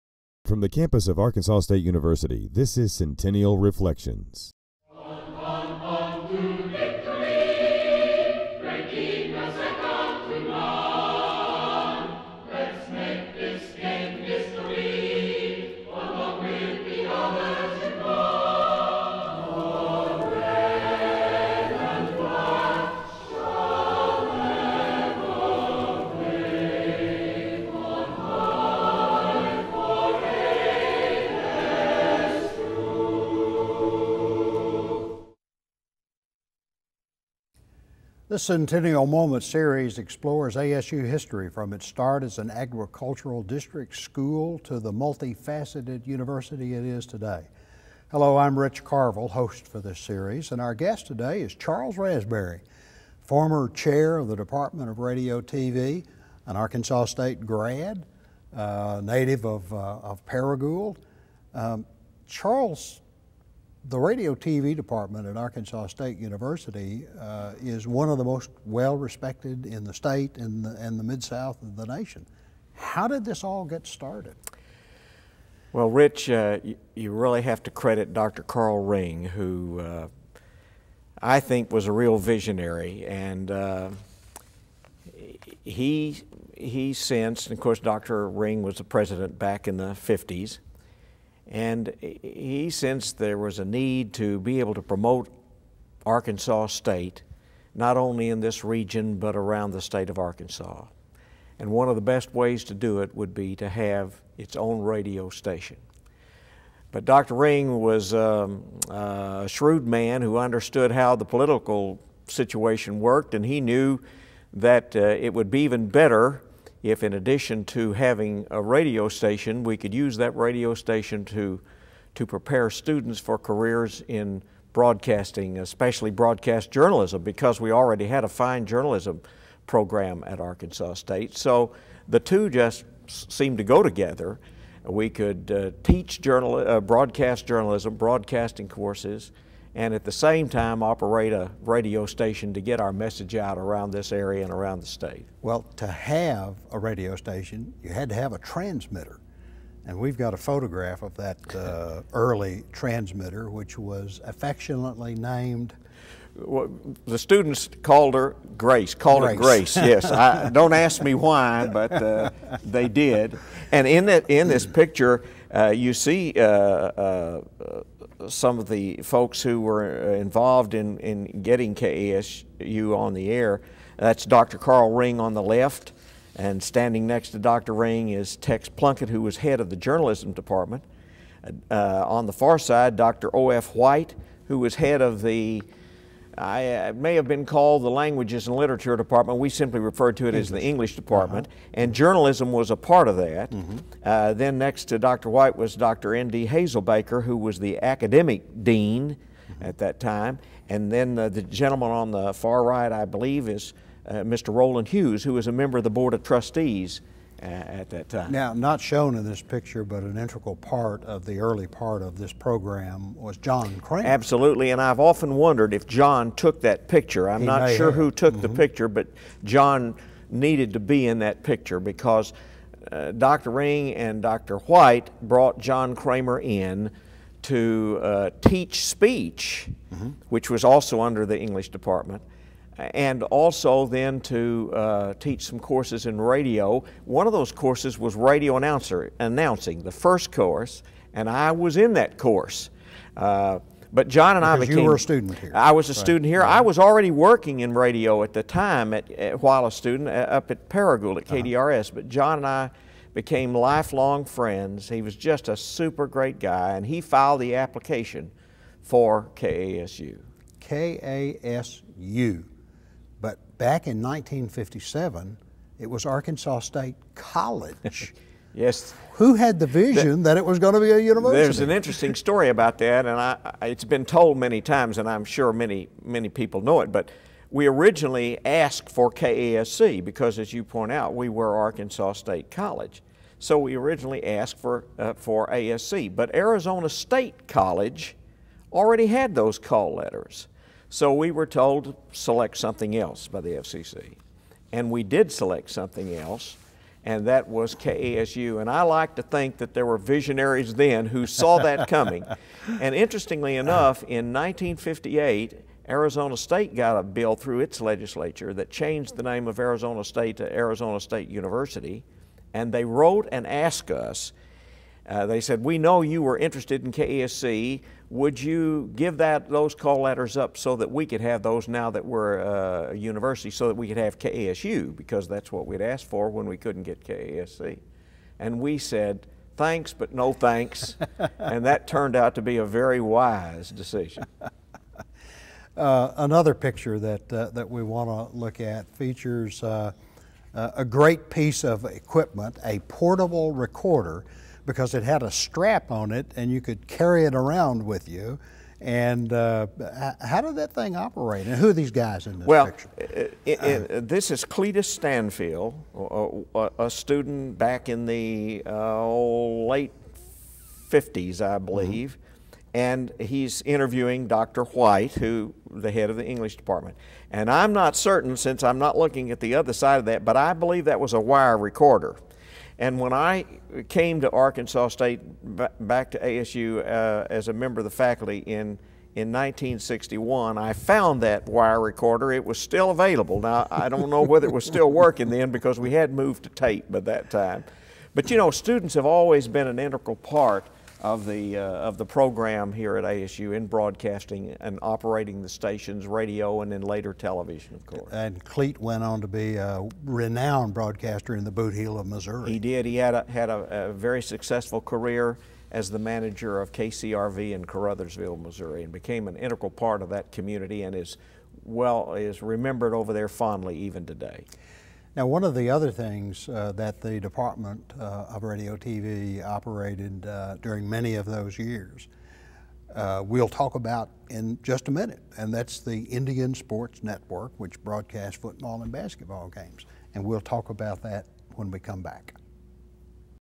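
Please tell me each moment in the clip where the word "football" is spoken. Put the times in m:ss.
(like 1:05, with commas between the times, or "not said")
7:08.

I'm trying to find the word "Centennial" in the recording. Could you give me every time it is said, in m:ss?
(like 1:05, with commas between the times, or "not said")
0:02, 0:38.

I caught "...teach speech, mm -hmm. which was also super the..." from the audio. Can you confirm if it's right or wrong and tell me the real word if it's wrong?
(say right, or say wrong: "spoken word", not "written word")
wrong: "under", not "super".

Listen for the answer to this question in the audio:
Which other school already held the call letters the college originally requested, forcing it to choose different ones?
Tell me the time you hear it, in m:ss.
4:46.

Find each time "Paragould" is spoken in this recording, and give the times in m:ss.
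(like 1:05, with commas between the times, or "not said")
1:00, 4:10.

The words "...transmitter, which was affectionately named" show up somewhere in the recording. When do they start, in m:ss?
2:32.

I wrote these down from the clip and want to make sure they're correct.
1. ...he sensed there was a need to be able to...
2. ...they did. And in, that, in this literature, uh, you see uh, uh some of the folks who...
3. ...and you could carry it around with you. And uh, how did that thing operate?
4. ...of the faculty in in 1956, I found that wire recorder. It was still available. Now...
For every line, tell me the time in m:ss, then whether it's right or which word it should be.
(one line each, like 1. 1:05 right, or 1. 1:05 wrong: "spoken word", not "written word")
1. 1:32 right
2. 2:42 wrong: "picture", not "literature"
3. 5:46 right
4. 6:17 wrong: "1961", not "1956".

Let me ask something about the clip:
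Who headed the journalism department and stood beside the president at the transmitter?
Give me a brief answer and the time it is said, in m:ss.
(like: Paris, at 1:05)
Tex Plunkett, at 2:58.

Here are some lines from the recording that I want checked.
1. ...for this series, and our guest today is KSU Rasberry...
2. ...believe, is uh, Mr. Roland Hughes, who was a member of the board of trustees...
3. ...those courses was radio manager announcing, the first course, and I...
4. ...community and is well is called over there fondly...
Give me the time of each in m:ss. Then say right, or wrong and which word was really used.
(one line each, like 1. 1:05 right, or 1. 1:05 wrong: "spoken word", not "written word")
1. 0:49 wrong: "Charles", not "KSU"
2. 3:23 right
3. 3:57 wrong: "announcer", not "manager"
4. 6:50 wrong: "remembered", not "called".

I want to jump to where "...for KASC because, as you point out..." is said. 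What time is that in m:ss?
4:38.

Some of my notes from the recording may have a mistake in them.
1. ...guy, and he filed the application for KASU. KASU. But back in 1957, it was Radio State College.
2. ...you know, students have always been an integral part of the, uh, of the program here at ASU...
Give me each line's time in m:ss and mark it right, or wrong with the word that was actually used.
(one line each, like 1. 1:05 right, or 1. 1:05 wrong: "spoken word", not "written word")
1. 4:16 wrong: "Arkansas", not "Radio"
2. 6:28 right.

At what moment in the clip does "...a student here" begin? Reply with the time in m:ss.
4:04.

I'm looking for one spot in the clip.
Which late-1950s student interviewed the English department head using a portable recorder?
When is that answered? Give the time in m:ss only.
5:54.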